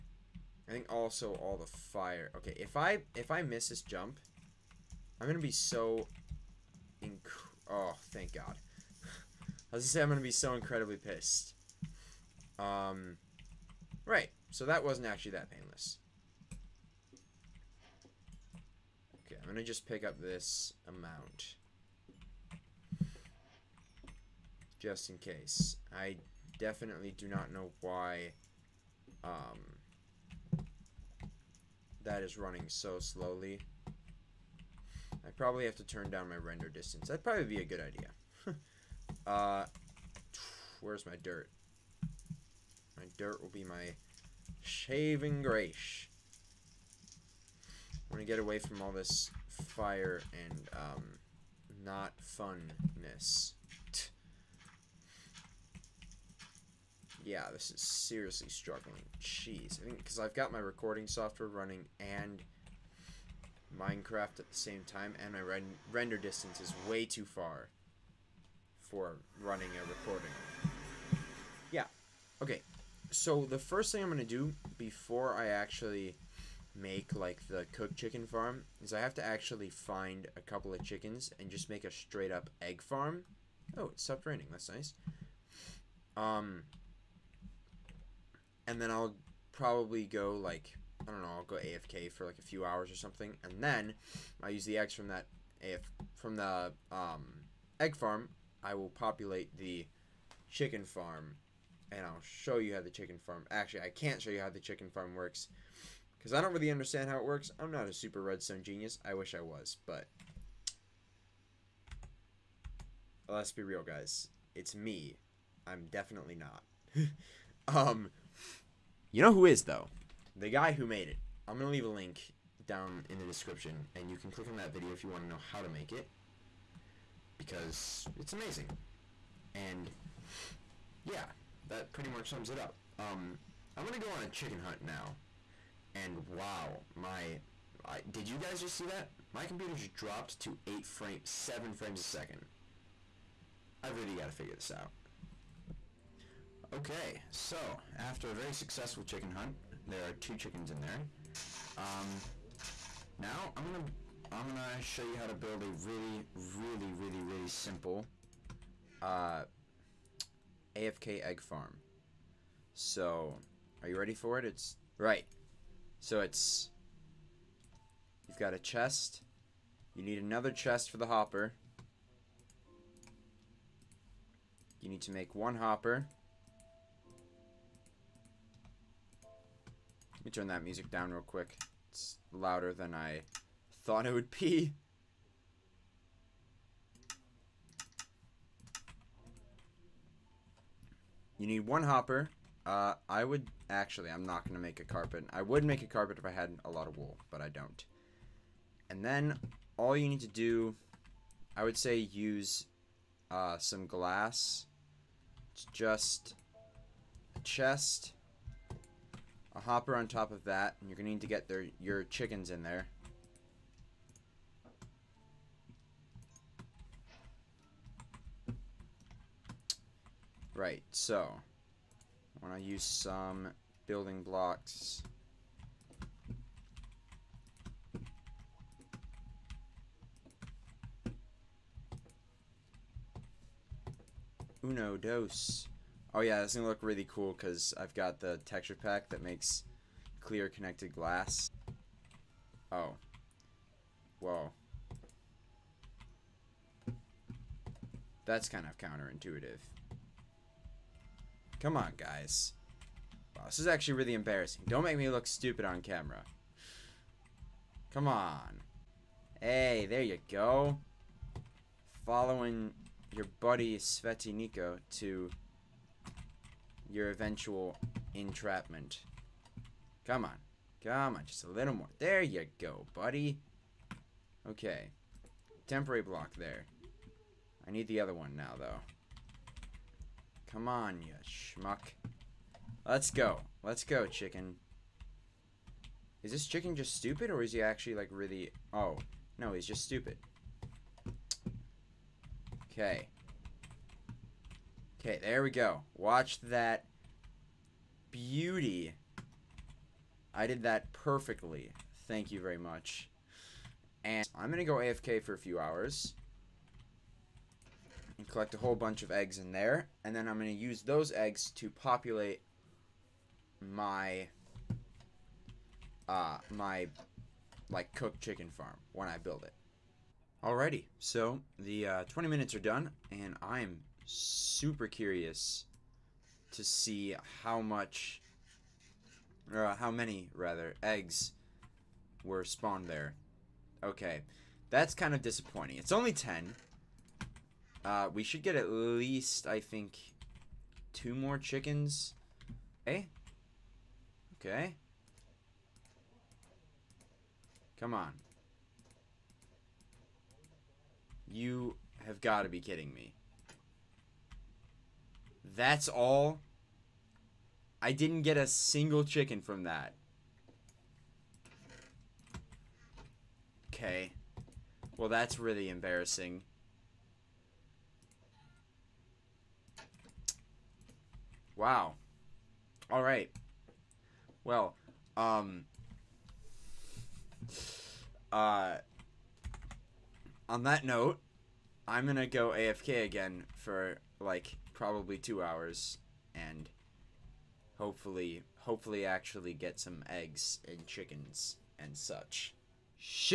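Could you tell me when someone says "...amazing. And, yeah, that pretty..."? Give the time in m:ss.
2:08.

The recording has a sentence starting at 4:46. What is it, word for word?
Is this chicken just stupid, or is he actually, like, really...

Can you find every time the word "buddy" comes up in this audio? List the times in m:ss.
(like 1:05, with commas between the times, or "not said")
4:23, 4:32.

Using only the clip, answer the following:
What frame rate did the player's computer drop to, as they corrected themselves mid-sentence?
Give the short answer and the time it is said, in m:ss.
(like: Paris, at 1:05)
7 frames a second, at 2:21.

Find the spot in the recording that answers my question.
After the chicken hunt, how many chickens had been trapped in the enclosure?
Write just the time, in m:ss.
2:30.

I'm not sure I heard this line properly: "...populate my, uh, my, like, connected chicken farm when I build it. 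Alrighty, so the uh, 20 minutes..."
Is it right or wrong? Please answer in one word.
wrong.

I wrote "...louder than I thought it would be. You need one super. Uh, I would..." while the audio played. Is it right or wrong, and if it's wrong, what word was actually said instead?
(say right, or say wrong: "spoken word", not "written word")
wrong: "hopper", not "super".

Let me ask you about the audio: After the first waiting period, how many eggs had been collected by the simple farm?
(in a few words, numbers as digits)
10.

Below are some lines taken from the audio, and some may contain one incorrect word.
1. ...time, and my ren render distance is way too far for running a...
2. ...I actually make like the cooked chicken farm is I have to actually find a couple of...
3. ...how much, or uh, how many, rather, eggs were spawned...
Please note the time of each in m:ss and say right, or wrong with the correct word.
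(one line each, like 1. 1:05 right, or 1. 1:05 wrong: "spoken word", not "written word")
1. 1:04 right
2. 1:15 right
3. 5:27 right.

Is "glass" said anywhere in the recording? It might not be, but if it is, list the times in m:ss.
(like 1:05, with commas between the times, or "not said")
3:23, 4:00.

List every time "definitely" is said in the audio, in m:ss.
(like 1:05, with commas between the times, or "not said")
0:26, 1:55.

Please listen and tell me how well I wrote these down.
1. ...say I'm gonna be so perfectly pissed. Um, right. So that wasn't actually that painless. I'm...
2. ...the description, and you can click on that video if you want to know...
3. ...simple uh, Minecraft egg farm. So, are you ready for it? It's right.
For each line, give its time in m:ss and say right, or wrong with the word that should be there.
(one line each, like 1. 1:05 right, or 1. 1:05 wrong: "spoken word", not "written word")
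1. 0:09 wrong: "incredibly", not "perfectly"
2. 2:03 right
3. 2:37 wrong: "AFK", not "Minecraft".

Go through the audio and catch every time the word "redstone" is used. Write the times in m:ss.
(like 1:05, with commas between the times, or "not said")
1:48.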